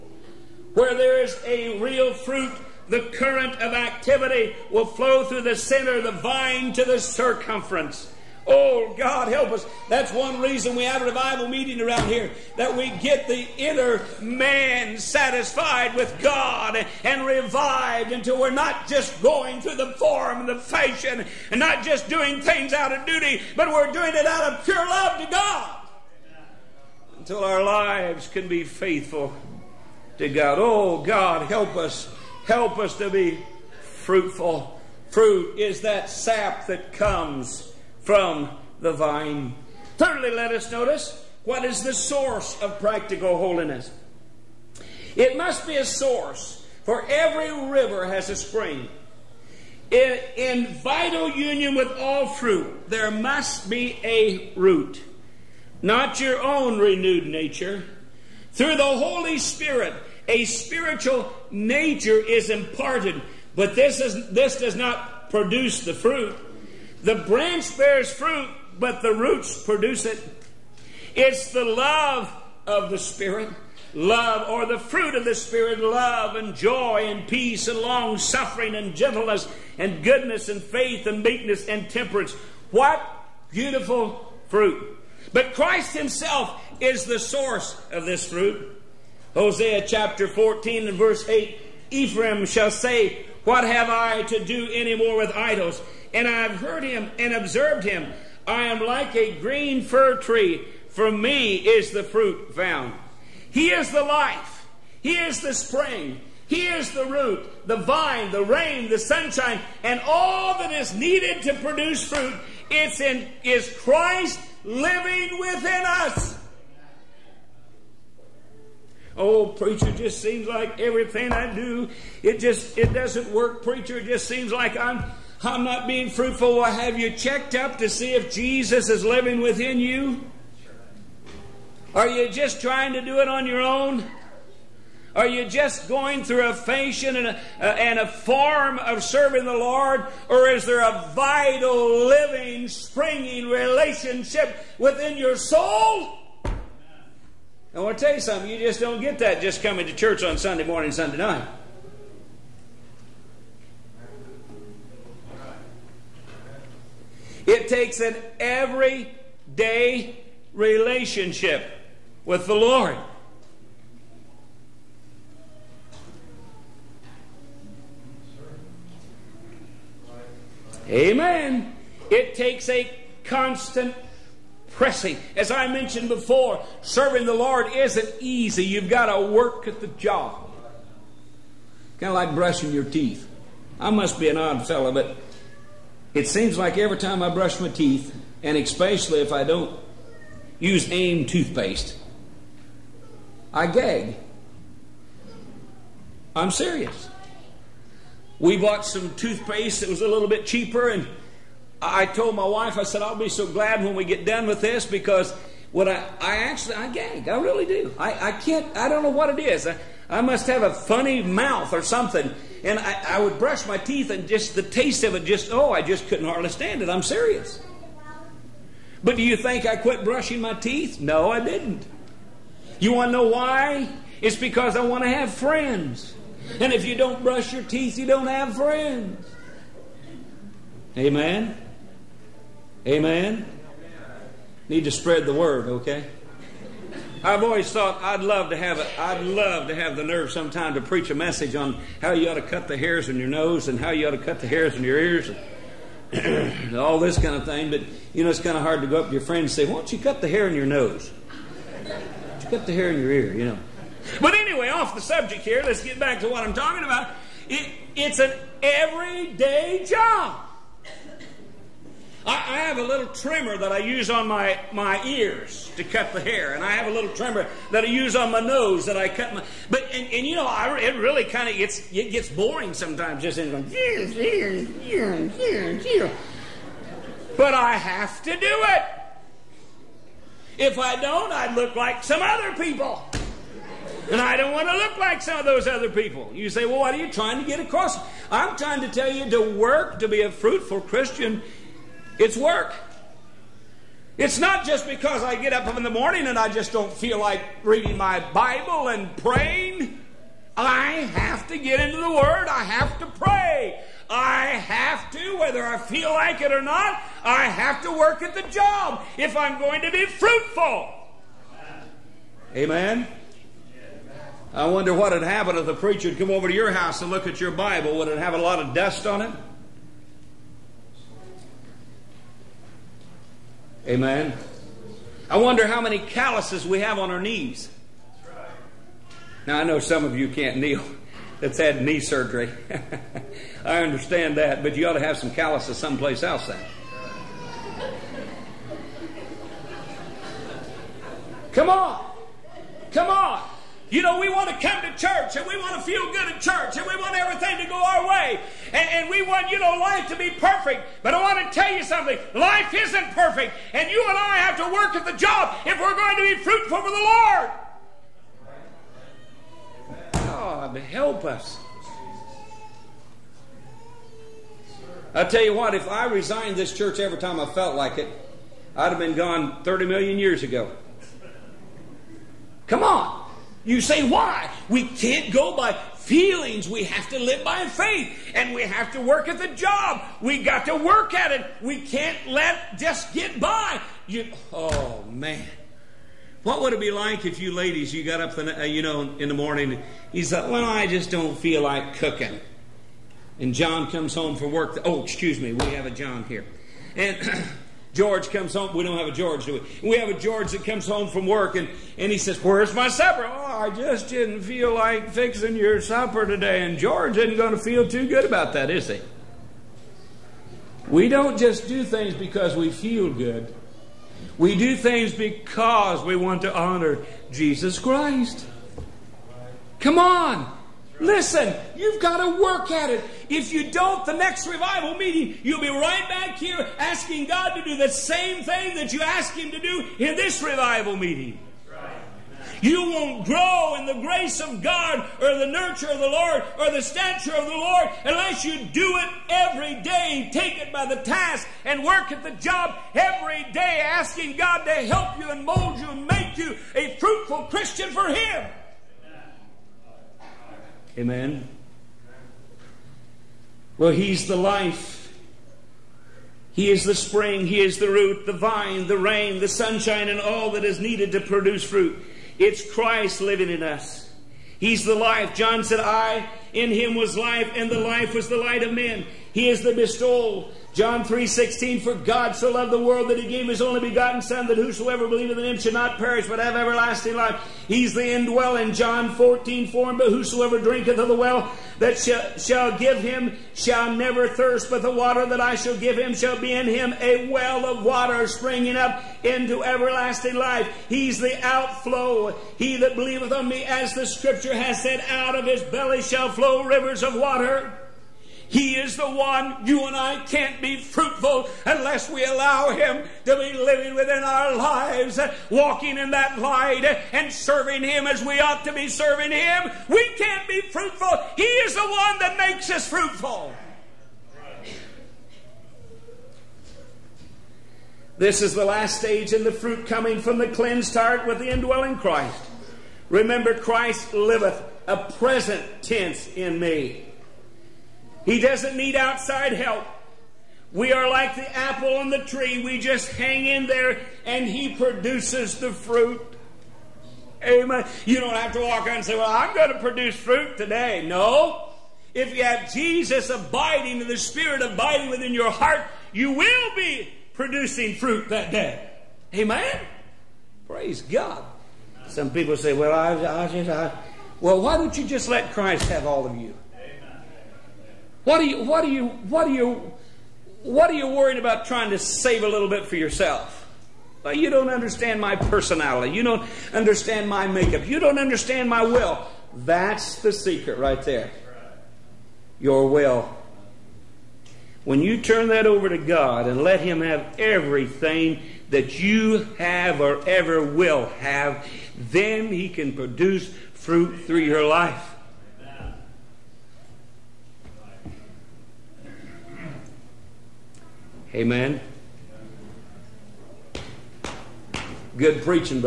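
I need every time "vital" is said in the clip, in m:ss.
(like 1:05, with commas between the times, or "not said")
0:50, 2:21.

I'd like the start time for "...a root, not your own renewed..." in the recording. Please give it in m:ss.
0:54.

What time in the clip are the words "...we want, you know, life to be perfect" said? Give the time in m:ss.
5:49.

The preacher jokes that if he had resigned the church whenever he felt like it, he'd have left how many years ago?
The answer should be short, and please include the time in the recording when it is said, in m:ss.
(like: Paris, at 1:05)
30 million, at 6:09.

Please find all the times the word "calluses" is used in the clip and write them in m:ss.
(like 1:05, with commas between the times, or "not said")
5:25, 5:35.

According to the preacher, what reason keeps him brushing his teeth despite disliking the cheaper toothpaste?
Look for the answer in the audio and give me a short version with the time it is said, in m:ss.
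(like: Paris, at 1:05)
to have friends, at 3:44.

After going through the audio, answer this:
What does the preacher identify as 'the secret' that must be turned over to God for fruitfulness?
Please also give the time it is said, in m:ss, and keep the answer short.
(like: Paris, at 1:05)
your will, at 9:32.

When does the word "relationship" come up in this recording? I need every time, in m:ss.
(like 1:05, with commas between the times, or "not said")
2:23, 2:40.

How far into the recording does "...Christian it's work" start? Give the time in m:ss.
4:50.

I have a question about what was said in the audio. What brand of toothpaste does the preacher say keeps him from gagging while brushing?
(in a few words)
AIM.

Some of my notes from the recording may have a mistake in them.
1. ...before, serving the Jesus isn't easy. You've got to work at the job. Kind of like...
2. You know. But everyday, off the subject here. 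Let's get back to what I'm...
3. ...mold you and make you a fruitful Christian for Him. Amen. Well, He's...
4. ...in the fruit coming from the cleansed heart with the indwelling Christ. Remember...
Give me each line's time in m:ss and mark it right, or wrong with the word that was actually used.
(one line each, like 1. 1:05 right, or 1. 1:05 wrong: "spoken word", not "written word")
1. 2:56 wrong: "Lord", not "Jesus"
2. 4:13 wrong: "anyway", not "everyday"
3. 7:25 right
4. 8:39 right.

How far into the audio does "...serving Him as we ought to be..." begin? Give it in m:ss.
8:27.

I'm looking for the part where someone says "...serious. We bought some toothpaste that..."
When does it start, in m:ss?
3:16.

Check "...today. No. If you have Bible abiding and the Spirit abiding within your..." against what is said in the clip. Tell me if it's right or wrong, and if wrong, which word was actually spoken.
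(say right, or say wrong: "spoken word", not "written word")
wrong: "Jesus", not "Bible".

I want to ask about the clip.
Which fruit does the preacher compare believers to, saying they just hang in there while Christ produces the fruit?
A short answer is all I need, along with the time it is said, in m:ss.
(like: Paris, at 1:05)
apple, at 8:51.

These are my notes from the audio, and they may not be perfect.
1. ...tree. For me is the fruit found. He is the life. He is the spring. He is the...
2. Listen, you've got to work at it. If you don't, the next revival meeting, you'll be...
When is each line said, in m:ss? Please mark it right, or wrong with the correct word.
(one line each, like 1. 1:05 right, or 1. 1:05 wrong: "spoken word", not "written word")
1. 1:40 right
2. 7:00 right.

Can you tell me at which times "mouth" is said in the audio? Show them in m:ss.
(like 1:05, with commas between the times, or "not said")
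3:31.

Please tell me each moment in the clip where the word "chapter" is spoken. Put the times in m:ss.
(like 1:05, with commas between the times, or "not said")
1:29.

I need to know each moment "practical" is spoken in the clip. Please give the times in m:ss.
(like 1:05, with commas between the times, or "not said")
0:42.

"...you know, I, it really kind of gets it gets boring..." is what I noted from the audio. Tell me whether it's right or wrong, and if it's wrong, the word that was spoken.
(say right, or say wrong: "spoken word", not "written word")
right.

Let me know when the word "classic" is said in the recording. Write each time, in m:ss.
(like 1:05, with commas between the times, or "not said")
not said.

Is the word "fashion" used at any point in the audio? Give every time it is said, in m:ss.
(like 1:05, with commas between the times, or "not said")
0:20, 2:16.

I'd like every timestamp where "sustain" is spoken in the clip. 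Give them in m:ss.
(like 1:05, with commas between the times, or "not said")
not said.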